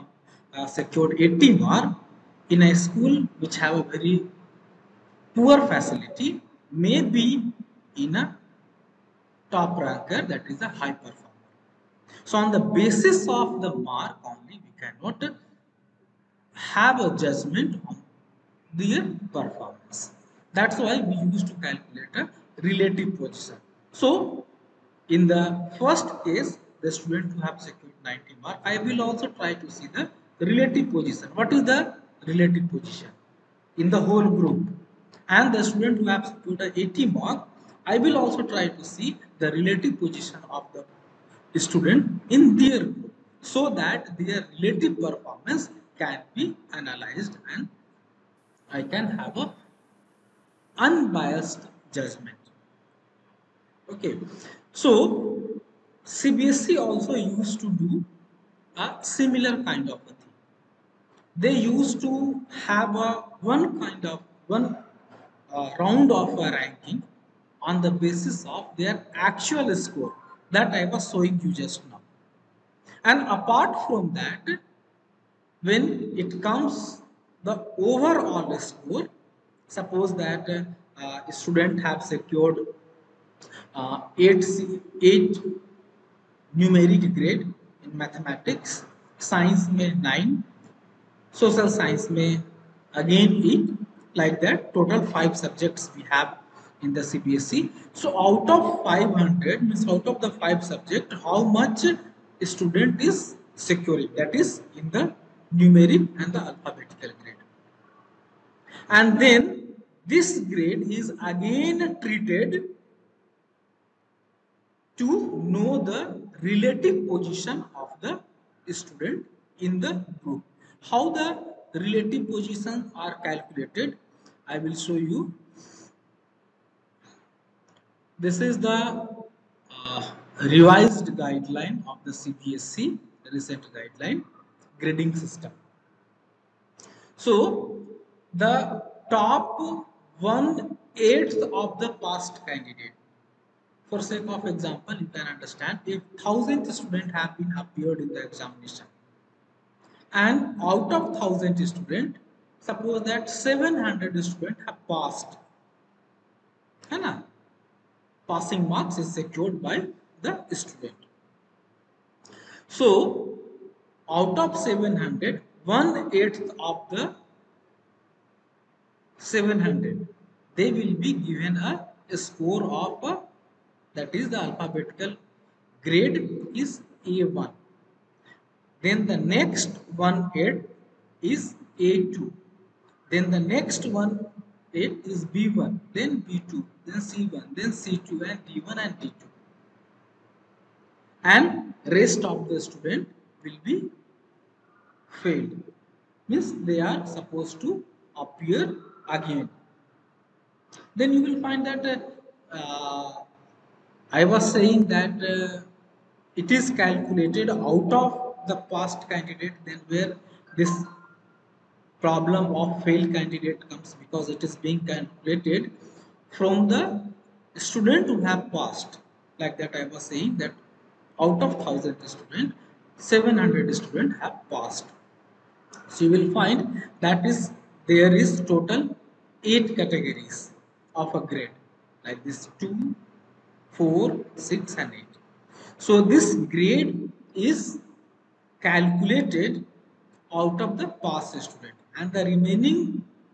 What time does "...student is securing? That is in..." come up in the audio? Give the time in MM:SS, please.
01:42.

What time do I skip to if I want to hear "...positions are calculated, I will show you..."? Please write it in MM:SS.
02:02.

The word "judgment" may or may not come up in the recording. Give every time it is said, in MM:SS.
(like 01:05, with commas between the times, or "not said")
00:17, 00:51.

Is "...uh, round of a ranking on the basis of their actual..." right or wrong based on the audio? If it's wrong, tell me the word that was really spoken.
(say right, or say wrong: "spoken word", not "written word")
right.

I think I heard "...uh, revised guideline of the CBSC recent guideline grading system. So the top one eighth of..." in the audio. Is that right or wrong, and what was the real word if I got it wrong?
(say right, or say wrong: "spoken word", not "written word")
right.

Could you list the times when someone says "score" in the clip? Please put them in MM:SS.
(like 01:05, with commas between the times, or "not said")
01:09, 01:18, 02:52.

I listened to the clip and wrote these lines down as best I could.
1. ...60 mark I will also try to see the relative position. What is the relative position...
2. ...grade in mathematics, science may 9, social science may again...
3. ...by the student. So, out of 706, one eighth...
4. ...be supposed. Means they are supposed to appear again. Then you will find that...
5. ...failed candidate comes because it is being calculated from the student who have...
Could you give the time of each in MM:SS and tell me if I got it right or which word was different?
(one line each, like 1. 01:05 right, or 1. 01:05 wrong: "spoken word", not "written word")
1. 00:28 wrong: "90", not "60"
2. 01:27 right
3. 02:39 wrong: "700", not "706"
4. 03:13 wrong: "failed", not "supposed"
5. 03:32 right.